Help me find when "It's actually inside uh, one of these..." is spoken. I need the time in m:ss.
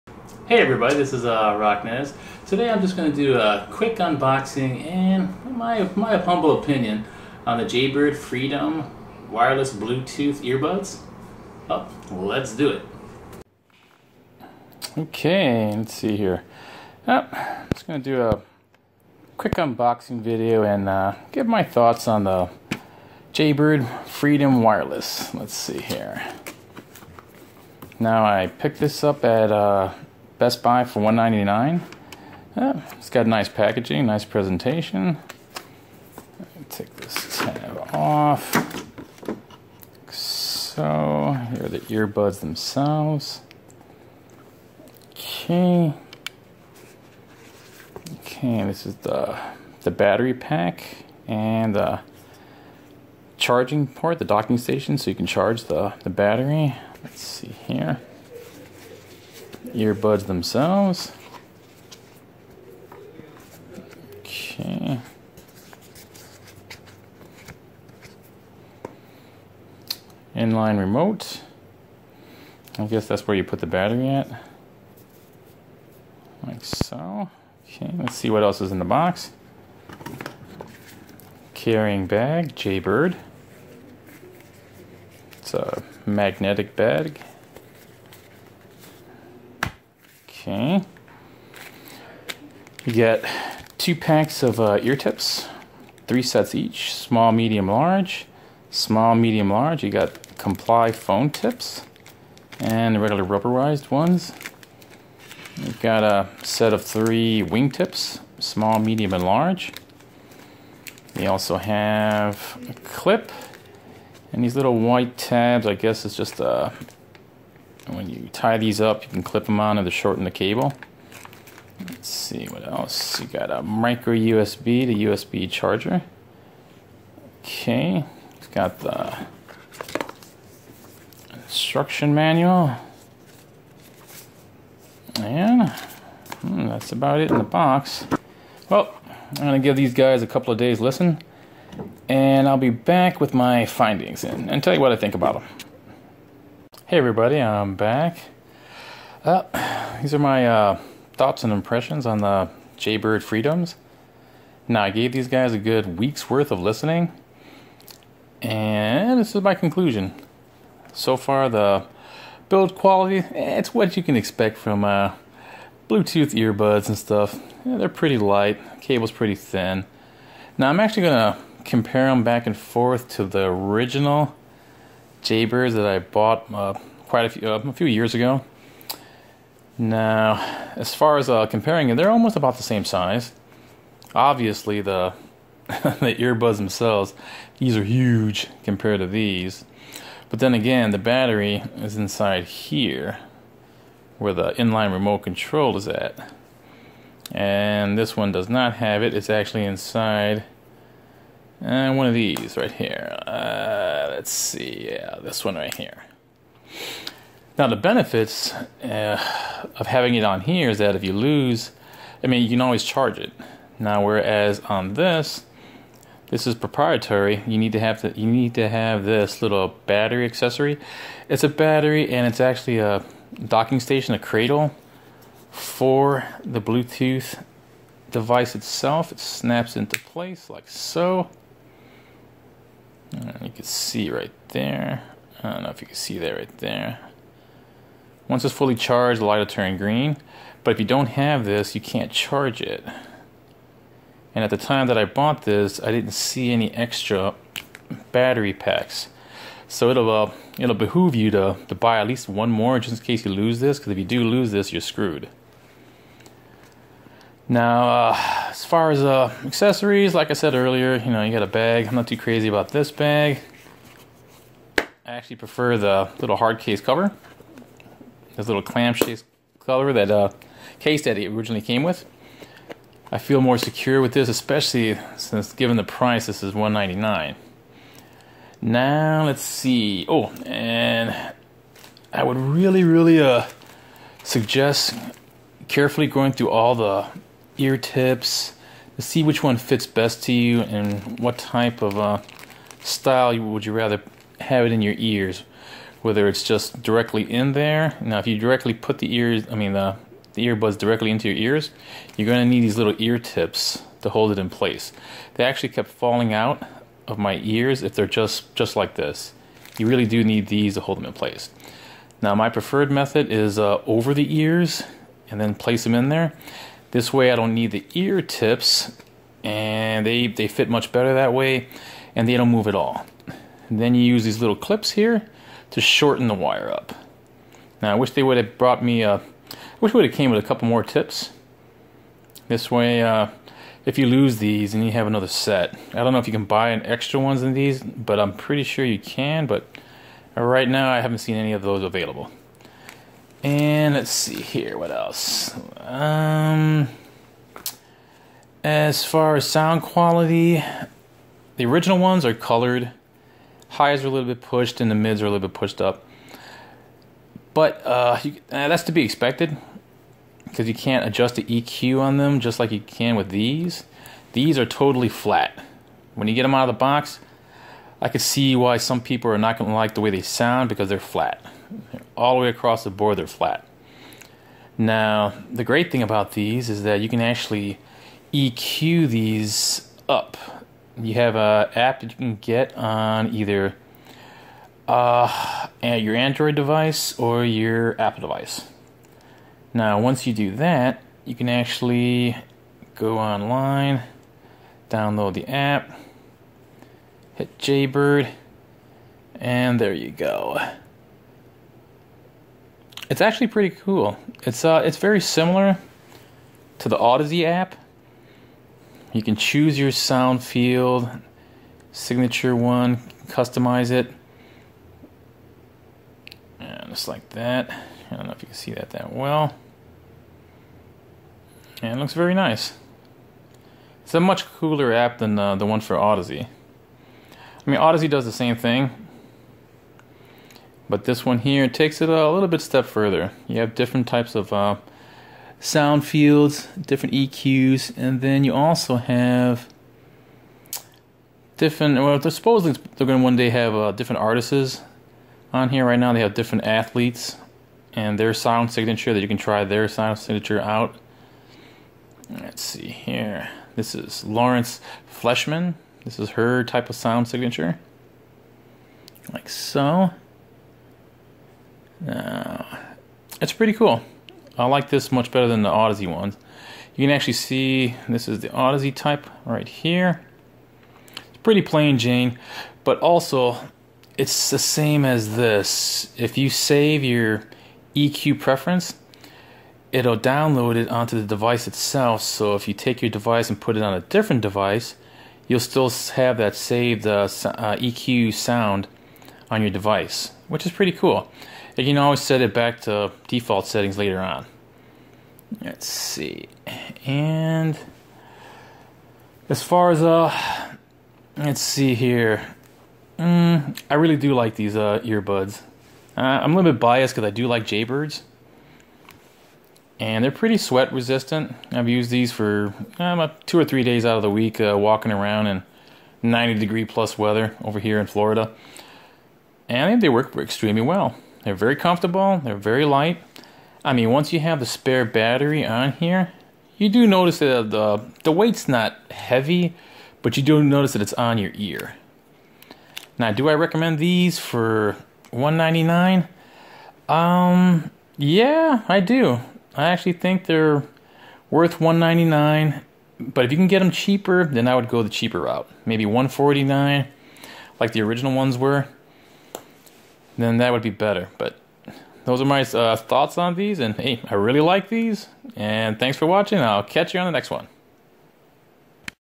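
3:19.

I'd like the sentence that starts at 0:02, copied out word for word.
Today I'm just going to do a quick unboxing and my, my humble opinion on the Jaybird Freedom wireless Bluetooth earbuds.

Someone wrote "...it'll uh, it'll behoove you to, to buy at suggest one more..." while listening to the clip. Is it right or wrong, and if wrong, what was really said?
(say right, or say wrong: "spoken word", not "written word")
wrong: "least", not "suggest".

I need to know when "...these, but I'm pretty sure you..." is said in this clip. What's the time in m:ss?
5:37.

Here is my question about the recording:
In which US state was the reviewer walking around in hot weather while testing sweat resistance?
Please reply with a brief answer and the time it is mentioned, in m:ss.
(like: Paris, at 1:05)
Florida, at 8:38.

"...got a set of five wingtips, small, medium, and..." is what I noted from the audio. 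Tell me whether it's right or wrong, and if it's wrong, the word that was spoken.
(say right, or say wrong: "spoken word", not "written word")
wrong: "three", not "five".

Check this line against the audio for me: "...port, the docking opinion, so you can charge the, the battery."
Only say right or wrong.
wrong.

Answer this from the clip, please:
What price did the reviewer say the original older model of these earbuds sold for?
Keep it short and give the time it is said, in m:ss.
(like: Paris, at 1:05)
$149, at 9:06.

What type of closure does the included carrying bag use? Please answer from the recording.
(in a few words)
Magnetic.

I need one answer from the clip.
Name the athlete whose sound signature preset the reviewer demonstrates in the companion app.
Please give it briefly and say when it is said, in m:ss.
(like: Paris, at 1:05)
Lauren Fleshman, at 7:34.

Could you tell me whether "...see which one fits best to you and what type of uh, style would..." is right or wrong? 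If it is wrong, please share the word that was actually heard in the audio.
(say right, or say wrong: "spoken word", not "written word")
right.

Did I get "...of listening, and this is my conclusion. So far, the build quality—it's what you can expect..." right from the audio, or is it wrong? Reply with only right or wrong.
right.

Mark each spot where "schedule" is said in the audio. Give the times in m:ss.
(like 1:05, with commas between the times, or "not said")
not said.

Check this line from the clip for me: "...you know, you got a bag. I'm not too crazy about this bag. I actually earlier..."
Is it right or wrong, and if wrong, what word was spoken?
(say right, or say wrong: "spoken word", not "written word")
wrong: "prefer", not "earlier".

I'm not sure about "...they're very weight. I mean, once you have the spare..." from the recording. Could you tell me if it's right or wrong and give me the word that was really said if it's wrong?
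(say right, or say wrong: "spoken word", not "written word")
wrong: "light", not "weight".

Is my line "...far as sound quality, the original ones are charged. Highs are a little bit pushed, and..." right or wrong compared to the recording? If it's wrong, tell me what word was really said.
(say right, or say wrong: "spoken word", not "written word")
wrong: "colored", not "charged".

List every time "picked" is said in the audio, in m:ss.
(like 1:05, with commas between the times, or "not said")
0:28.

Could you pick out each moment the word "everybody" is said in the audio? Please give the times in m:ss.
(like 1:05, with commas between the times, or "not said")
0:00, 2:26.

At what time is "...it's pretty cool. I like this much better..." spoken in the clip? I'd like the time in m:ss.
7:43.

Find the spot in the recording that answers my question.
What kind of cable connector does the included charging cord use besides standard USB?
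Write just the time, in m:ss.
2:03.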